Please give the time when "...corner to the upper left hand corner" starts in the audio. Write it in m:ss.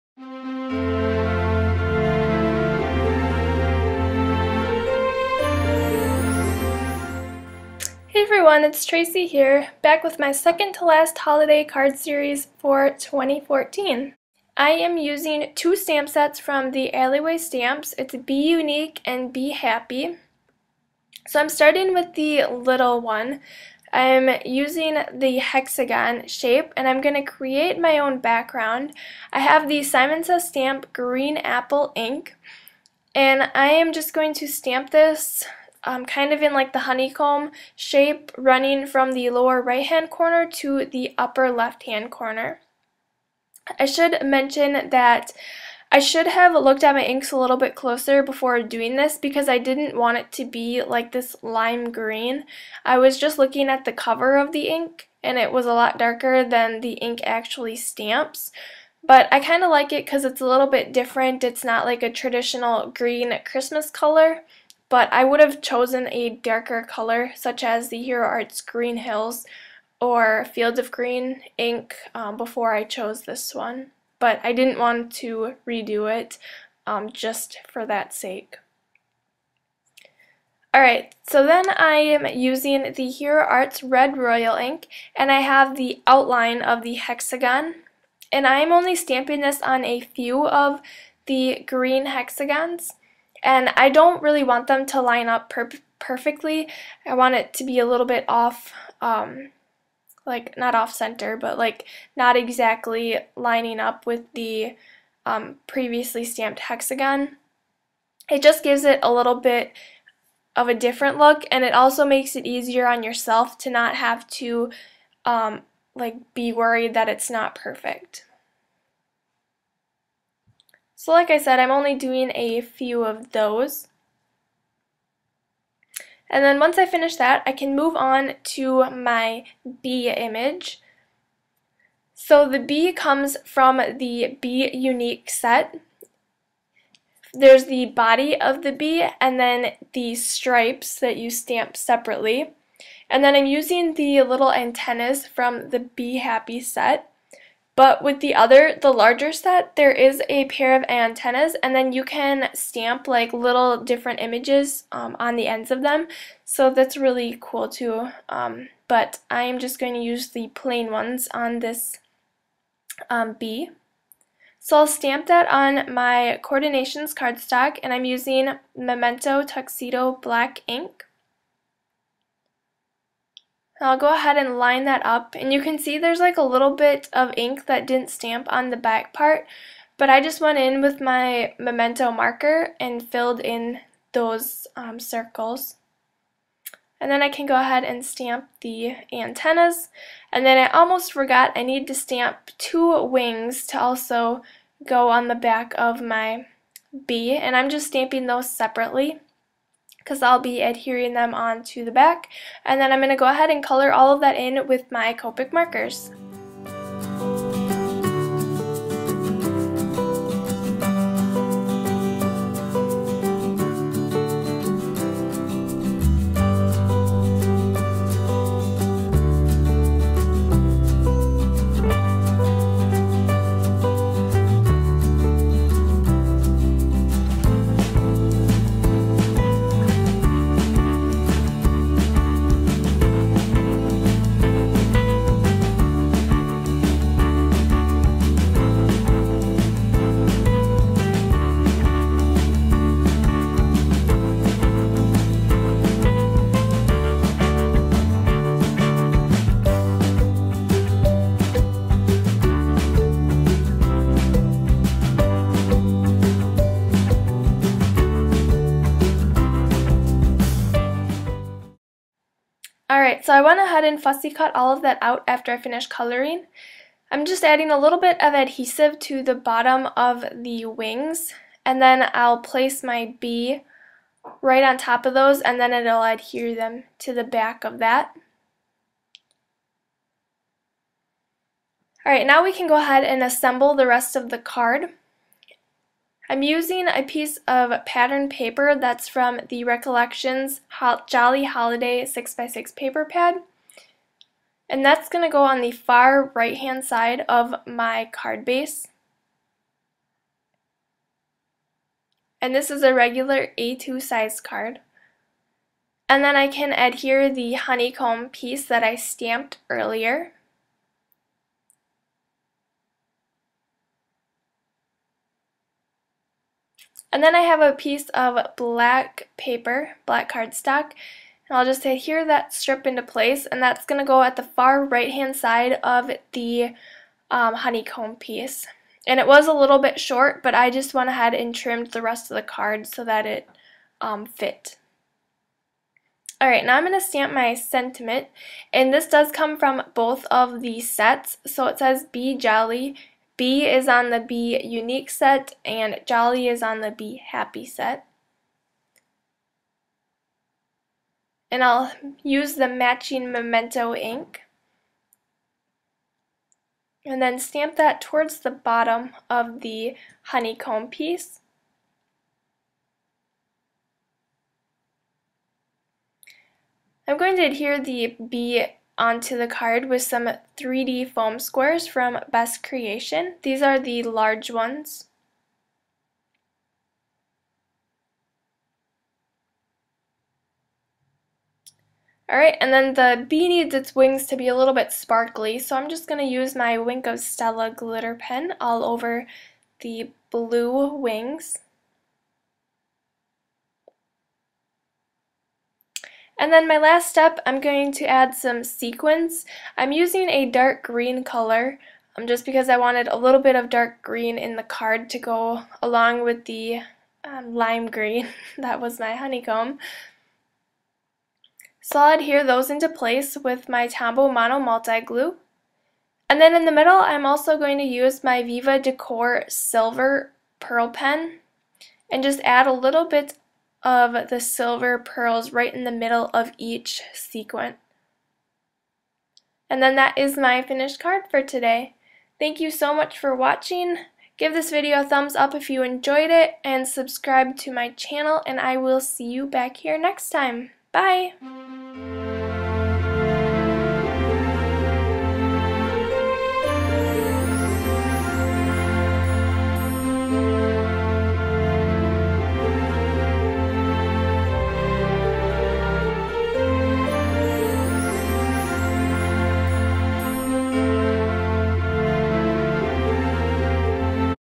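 0:40.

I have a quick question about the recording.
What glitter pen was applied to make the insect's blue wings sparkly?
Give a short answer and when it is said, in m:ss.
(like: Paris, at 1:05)
Wink of Stella, at 6:26.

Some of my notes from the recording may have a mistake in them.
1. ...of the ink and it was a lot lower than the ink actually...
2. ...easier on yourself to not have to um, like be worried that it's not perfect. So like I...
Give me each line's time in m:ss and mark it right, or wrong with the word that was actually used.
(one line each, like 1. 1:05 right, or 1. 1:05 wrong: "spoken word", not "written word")
1. 0:54 wrong: "darker", not "lower"
2. 1:52 right.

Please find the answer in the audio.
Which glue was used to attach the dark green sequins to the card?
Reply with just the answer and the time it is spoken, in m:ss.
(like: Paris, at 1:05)
Tombow Mono Multi Glue, at 6:53.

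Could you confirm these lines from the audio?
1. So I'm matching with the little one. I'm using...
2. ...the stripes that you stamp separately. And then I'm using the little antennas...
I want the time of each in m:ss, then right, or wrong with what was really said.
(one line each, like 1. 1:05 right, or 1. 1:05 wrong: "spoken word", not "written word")
1. 0:21 wrong: "starting", not "matching"
2. 2:19 right.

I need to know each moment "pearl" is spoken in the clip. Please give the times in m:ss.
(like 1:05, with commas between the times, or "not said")
7:00, 7:04.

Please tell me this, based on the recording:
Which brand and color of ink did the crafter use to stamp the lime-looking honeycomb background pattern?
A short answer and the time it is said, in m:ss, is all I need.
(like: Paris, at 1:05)
Simon Says Stamp Green Apple, at 0:29.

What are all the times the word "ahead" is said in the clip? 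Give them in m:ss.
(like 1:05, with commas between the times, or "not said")
2:54, 3:07, 3:23, 4:23, 4:42, 5:31.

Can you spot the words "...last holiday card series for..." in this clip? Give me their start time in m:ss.
0:10.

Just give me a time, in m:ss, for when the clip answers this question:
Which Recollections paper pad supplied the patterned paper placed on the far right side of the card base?
4:51.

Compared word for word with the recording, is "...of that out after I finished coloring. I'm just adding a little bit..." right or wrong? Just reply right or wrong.
right.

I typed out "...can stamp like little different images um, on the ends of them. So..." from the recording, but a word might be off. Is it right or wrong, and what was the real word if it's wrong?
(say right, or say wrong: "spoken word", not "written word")
right.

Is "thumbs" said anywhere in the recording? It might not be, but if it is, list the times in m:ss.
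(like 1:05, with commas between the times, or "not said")
7:15.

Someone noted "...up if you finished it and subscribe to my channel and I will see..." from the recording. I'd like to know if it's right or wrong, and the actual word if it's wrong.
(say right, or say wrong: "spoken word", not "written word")
wrong: "enjoyed", not "finished".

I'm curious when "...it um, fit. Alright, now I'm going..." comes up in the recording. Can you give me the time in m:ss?
5:33.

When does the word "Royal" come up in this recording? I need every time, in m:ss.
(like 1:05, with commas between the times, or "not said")
1:24.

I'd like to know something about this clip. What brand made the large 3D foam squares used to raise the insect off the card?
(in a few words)
Best Creation.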